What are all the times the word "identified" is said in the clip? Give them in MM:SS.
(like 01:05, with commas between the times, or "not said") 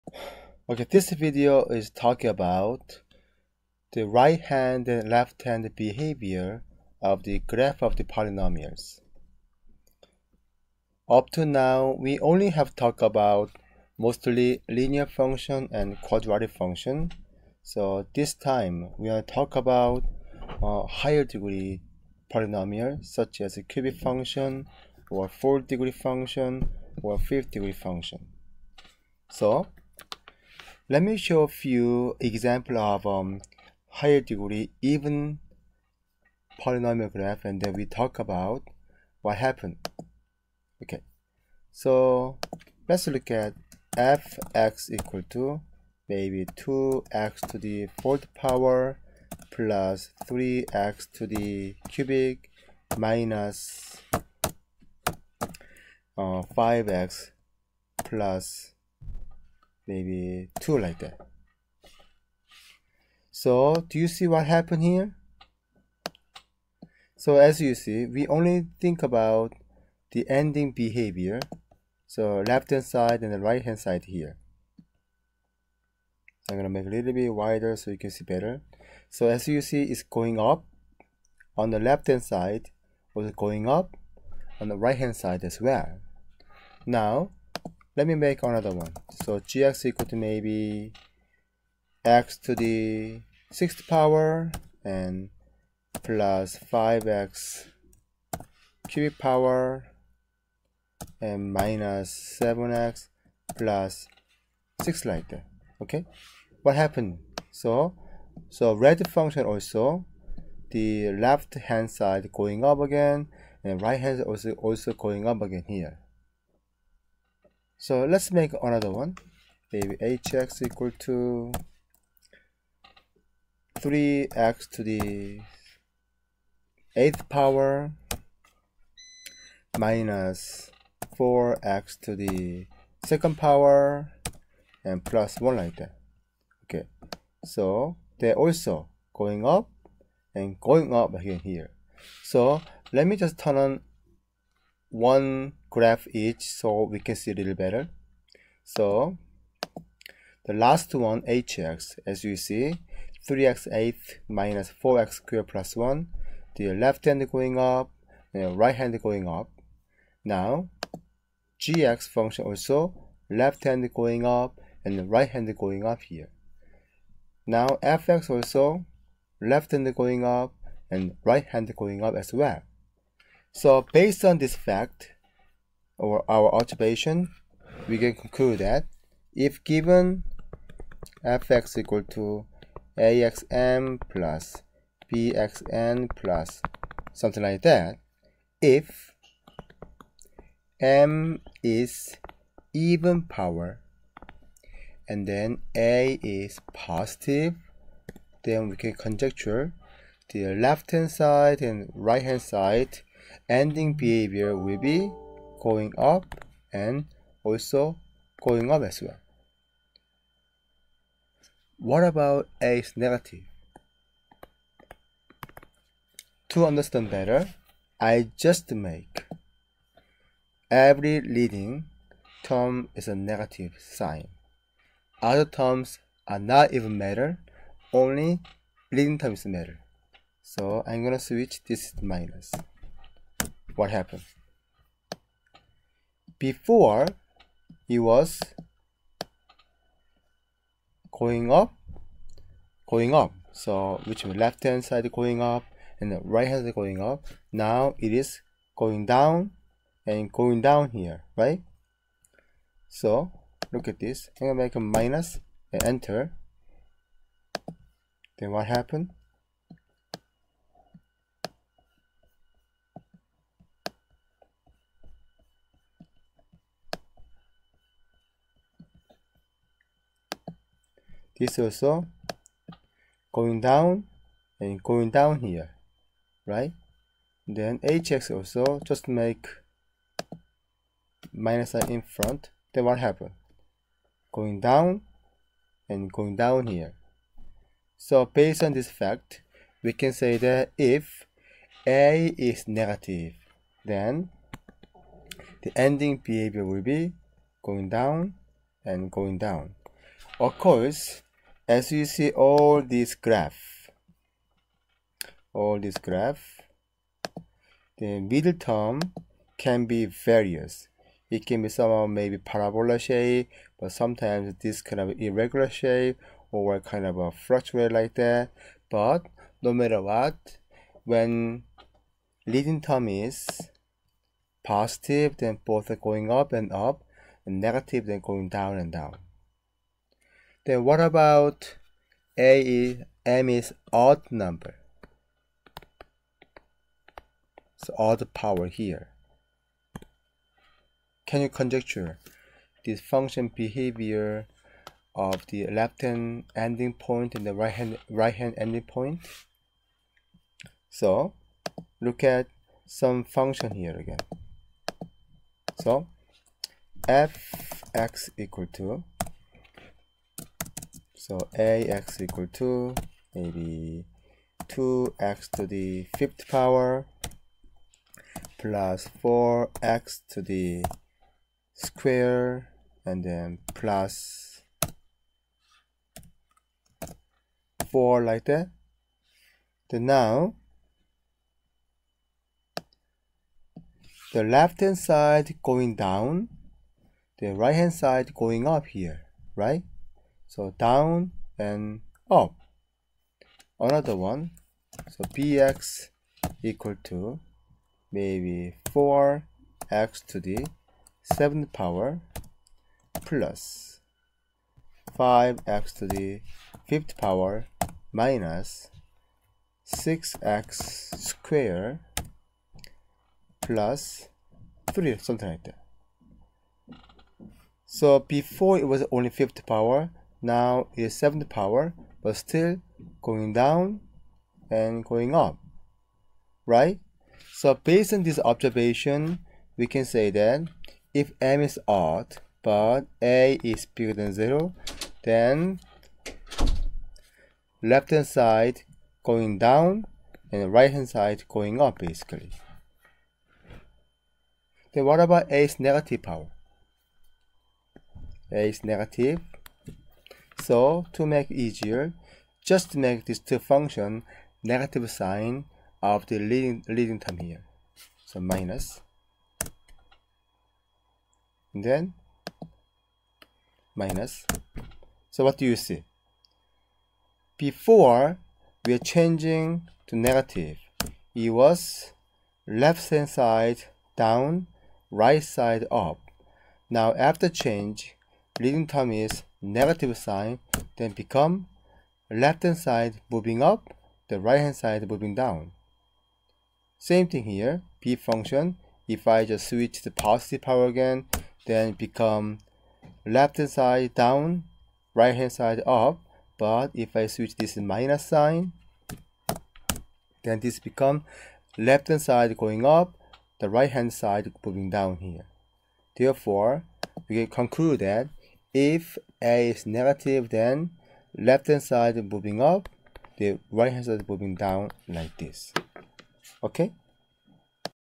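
not said.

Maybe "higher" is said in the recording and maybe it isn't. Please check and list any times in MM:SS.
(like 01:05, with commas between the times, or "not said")
00:20, 00:33.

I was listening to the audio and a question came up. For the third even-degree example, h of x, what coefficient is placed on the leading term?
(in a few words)
3.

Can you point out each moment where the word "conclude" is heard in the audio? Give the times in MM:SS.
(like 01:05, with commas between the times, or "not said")
02:58, 08:27.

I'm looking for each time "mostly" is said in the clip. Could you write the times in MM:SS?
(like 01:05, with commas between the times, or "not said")
00:13.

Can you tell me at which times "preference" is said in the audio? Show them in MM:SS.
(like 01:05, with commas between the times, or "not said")
not said.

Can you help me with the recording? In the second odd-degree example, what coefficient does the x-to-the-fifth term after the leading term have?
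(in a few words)
5.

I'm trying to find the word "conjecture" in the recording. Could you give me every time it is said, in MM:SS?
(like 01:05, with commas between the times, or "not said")
03:18, 05:41.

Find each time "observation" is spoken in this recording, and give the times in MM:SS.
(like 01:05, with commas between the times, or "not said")
02:56, 07:08.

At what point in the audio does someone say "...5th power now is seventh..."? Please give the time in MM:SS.
06:59.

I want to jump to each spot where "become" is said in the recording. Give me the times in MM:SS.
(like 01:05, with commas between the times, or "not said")
08:01, 08:11, 08:20.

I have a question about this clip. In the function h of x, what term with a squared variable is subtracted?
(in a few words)
4x squared.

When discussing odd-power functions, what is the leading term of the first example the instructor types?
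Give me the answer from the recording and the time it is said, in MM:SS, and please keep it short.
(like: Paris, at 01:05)
2x^5, at 06:04.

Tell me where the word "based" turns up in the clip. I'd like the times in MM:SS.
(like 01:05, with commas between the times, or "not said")
02:53, 04:48, 07:07.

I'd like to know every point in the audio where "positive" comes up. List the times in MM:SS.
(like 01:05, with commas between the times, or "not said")
03:16, 05:24, 08:10.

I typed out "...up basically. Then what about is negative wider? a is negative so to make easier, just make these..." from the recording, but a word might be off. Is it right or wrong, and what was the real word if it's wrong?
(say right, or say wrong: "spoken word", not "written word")
wrong: "power", not "wider".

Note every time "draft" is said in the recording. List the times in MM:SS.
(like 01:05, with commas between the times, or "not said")
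not said.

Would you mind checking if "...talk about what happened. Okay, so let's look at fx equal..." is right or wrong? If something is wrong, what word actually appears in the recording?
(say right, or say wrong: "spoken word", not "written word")
right.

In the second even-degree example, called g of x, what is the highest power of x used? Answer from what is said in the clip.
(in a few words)
6.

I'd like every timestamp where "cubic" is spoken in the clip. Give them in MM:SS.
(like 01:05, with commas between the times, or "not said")
00:23, 00:51, 01:38.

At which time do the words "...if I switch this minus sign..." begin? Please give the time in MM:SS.
08:16.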